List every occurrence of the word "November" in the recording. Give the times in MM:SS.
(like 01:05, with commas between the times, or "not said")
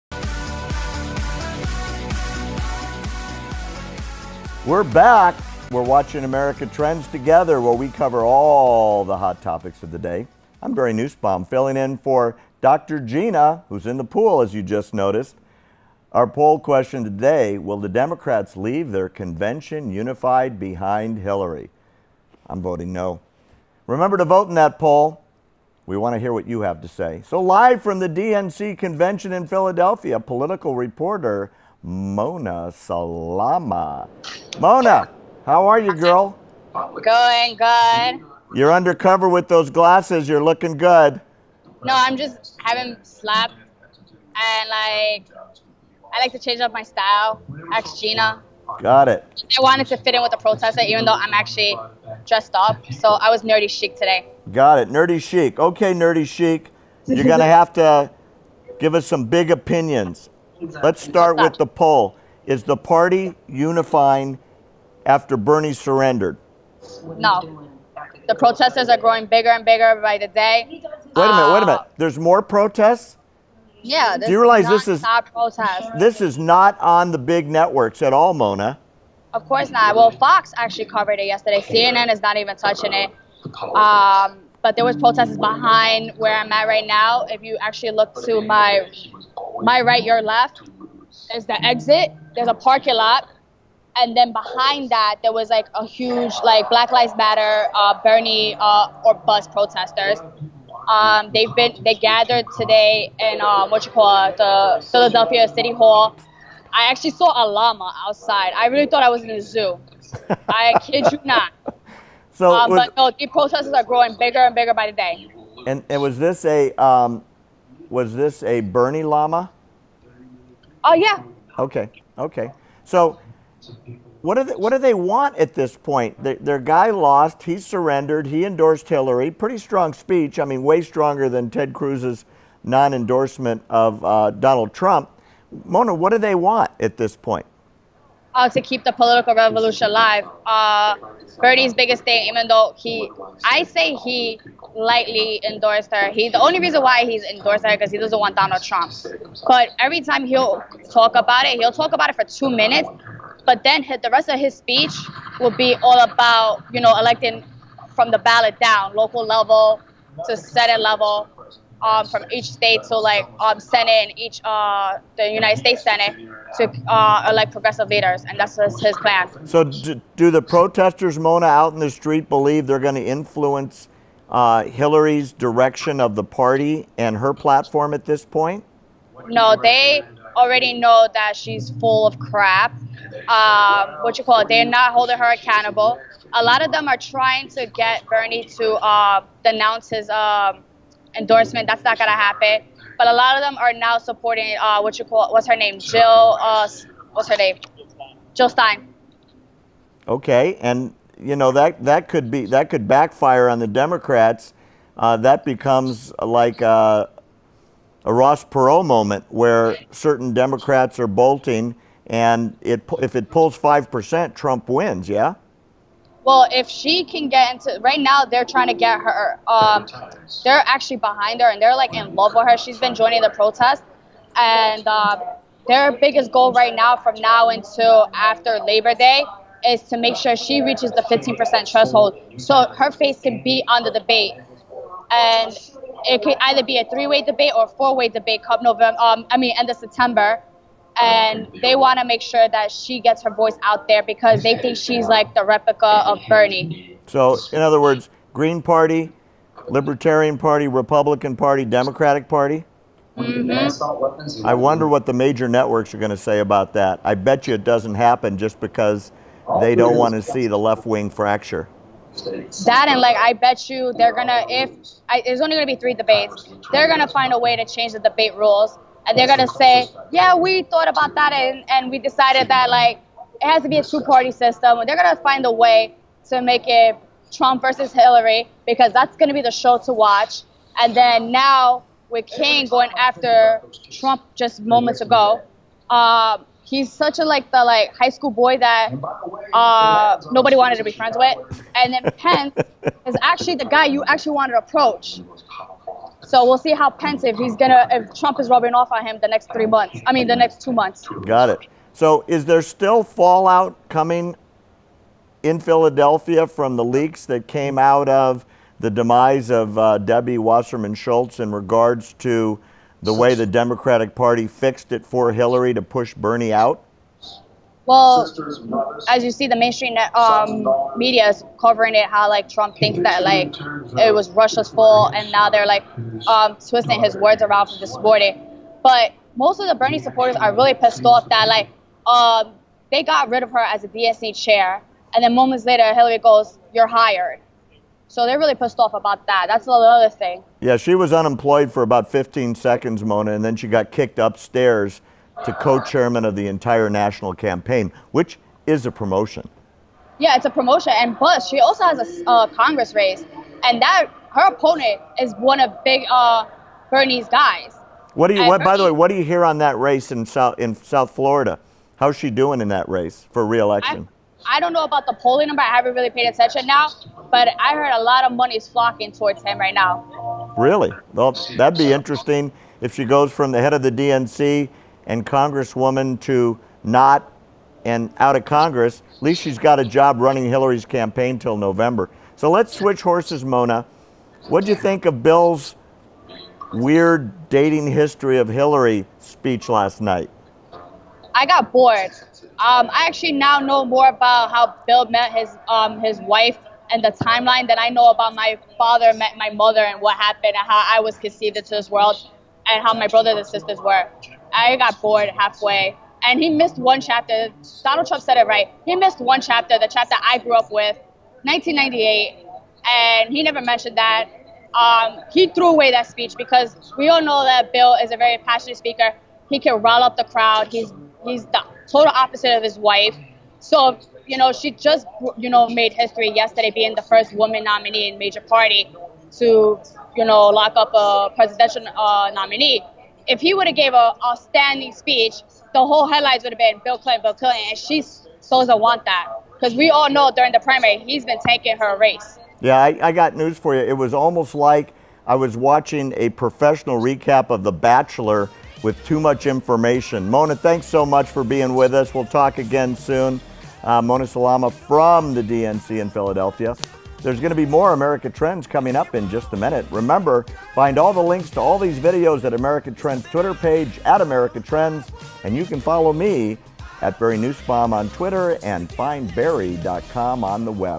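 03:58, 06:21.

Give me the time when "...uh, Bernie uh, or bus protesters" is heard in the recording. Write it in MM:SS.
01:37.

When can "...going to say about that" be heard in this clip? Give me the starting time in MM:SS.
04:15.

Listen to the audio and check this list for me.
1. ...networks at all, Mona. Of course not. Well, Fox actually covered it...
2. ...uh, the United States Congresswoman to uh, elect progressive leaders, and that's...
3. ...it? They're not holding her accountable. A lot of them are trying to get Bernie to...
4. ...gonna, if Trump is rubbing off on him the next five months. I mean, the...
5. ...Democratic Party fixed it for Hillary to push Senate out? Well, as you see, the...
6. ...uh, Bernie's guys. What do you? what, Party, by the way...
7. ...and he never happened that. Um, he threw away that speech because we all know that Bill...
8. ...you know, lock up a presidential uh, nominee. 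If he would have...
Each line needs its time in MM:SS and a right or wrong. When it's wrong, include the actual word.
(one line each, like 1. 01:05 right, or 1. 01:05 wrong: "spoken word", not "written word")
1. 01:17 right
2. 02:44 wrong: "Senate", not "Congresswoman"
3. 03:04 right
4. 04:57 wrong: "three", not "five"
5. 05:13 wrong: "Bernie", not "Senate"
6. 05:56 wrong: "Bernie", not "Party"
7. 06:52 wrong: "mentioned", not "happened"
8. 07:10 right.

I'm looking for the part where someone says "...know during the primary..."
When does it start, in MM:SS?
07:20.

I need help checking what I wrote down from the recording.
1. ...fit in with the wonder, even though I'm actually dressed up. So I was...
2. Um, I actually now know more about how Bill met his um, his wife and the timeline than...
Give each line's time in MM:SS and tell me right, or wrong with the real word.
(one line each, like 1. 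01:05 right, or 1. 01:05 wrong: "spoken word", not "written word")
1. 00:49 wrong: "protester", not "wonder"
2. 06:32 right.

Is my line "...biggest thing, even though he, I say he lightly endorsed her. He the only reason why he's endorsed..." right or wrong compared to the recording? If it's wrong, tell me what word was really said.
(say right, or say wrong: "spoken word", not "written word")
right.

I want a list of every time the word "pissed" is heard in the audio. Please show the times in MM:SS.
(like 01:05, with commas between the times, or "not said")
05:30, 05:38.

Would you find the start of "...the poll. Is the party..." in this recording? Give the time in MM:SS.
01:01.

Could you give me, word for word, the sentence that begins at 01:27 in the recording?
If you actually look to my my right, your left.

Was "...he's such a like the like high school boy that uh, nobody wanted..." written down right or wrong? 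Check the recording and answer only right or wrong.
right.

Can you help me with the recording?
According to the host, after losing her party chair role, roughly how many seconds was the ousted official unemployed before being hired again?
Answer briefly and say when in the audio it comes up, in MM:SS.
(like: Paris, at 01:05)
15 seconds, at 05:42.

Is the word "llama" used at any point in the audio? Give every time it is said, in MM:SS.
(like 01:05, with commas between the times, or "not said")
01:47, 01:59.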